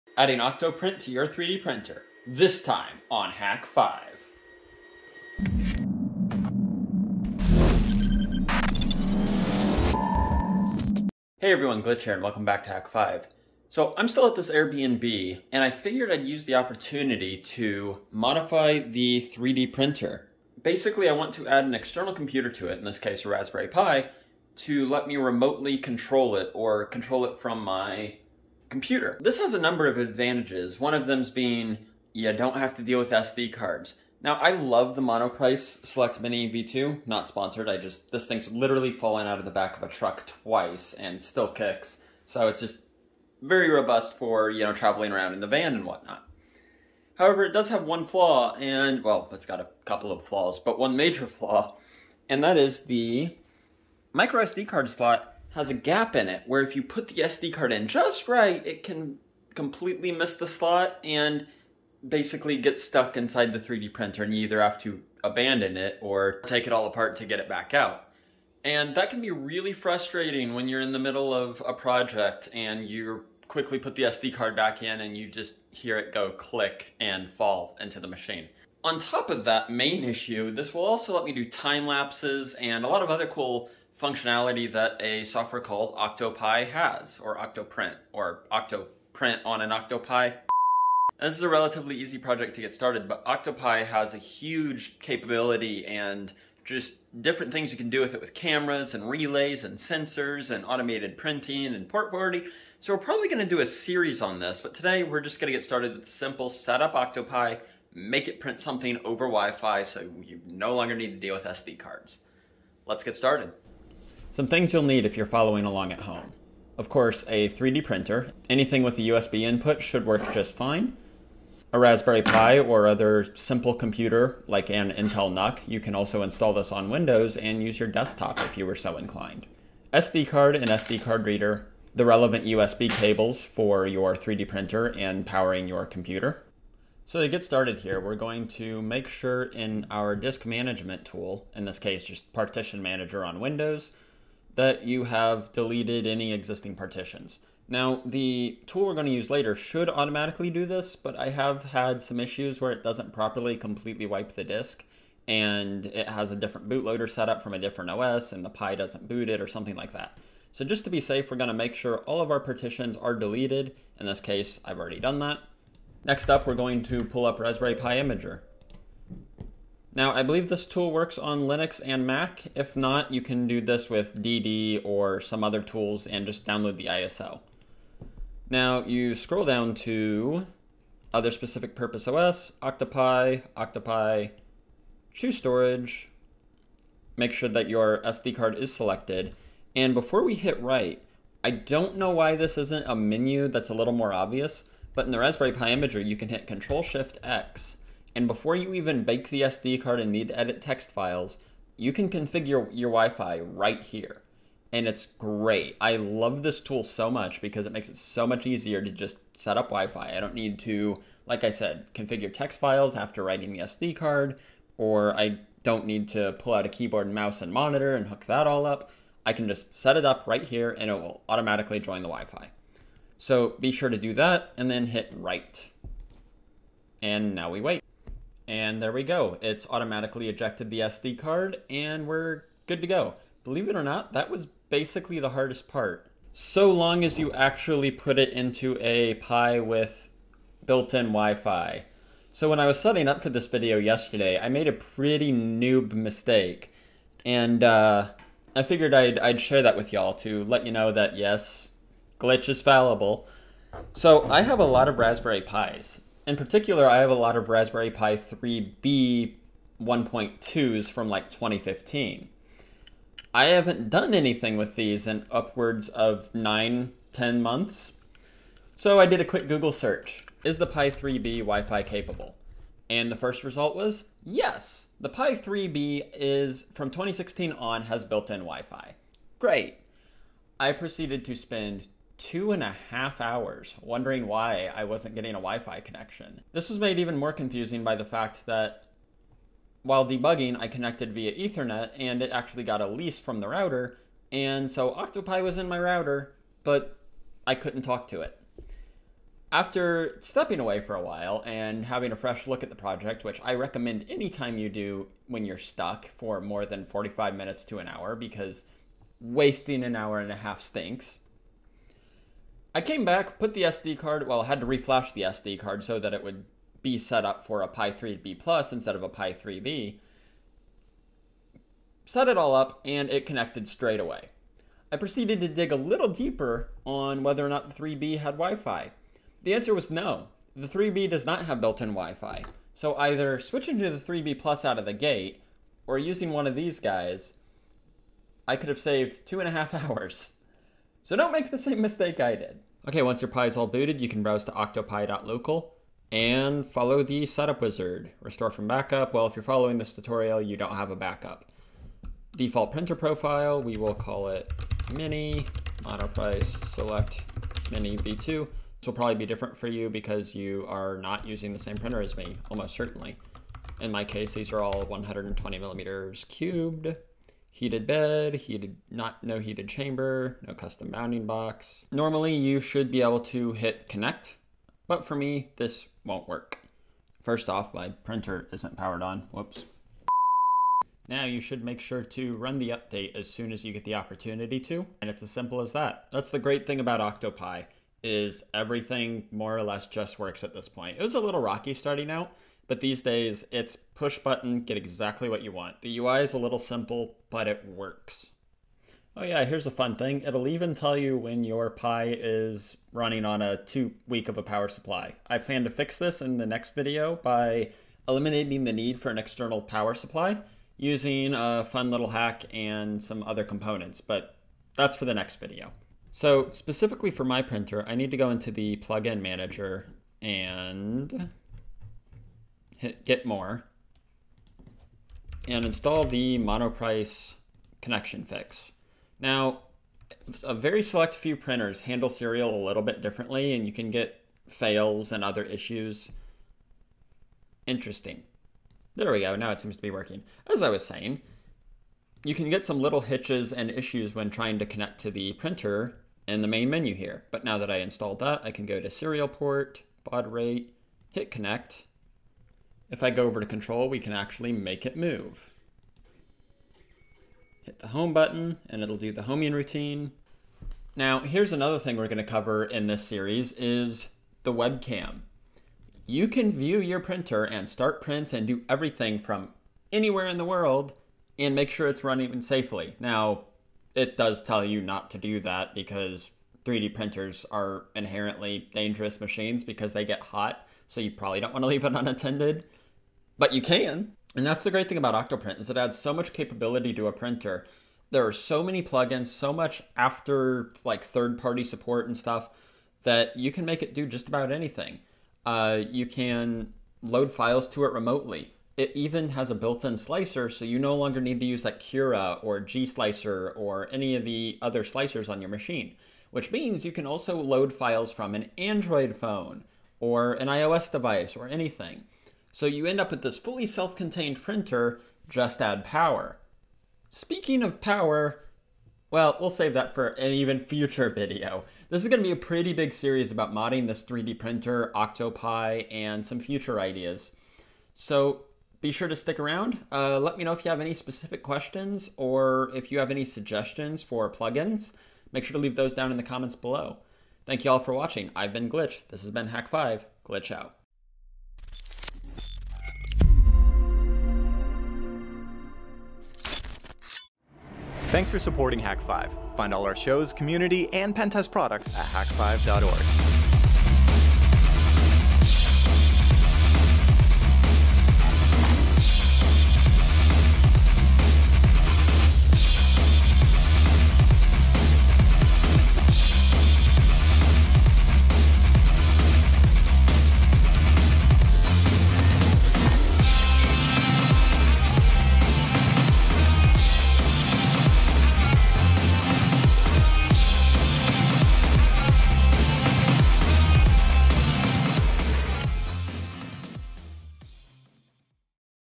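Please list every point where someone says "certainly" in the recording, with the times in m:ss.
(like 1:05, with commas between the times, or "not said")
6:02.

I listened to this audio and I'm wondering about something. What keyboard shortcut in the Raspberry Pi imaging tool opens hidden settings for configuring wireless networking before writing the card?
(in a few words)
Control Shift X.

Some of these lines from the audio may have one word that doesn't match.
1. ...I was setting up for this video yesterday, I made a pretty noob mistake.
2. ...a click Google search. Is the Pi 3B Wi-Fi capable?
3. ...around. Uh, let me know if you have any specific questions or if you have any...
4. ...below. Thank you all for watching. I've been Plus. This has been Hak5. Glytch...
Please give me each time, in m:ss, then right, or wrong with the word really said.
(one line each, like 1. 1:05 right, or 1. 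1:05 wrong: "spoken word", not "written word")
1. 4:02 right
2. 4:29 wrong: "quick", not "click"
3. 8:49 right
4. 8:56 wrong: "Glytch", not "Plus".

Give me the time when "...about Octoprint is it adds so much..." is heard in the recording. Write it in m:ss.
8:04.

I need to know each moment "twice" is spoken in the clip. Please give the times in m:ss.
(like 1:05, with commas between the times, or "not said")
0:40.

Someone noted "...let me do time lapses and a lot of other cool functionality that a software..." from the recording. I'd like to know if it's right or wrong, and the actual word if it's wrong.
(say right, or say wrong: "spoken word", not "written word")
right.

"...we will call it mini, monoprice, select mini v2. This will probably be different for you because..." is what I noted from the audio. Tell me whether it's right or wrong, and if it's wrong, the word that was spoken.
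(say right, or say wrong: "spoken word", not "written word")
right.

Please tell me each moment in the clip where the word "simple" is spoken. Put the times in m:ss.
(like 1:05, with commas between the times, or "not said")
1:46, 2:03, 6:25, 6:36.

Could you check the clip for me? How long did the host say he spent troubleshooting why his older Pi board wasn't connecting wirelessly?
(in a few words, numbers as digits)
Two and a half hours.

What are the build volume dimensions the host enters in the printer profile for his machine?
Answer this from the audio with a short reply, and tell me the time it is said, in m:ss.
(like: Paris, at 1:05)
120 millimeters cubed, at 6:04.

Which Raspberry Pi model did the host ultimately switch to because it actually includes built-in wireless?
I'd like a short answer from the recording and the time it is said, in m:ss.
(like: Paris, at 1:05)
Pi 3B Plus, at 5:17.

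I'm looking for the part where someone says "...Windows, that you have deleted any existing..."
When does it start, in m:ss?
2:23.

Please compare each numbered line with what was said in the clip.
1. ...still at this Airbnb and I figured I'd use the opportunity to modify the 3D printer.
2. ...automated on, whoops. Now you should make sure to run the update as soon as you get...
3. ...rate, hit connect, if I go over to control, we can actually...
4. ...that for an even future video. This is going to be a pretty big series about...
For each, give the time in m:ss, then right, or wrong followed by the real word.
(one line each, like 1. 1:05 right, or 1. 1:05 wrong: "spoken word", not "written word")
1. 0:14 right
2. 6:18 wrong: "powered", not "automated"
3. 7:30 right
4. 8:39 right.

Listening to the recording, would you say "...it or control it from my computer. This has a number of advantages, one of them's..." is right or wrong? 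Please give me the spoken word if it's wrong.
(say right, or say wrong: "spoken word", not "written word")
right.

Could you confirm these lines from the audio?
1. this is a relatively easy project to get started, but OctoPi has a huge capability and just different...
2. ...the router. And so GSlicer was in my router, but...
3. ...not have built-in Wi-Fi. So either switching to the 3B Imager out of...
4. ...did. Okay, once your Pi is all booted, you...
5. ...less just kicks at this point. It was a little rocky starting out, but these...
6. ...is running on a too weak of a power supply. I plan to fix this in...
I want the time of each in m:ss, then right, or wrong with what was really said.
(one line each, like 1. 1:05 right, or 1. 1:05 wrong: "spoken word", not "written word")
1. 1:31 right
2. 4:53 wrong: "Octopi", not "GSlicer"
3. 5:31 wrong: "Plus", not "Imager"
4. 5:42 right
5. 6:29 wrong: "works", not "kicks"
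6. 6:42 right.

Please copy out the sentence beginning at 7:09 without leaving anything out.
Now, a very select few printers handle serial a little bit differently, and you can get fails and other issues.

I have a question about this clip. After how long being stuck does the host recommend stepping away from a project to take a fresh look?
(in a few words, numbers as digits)
45 minutes.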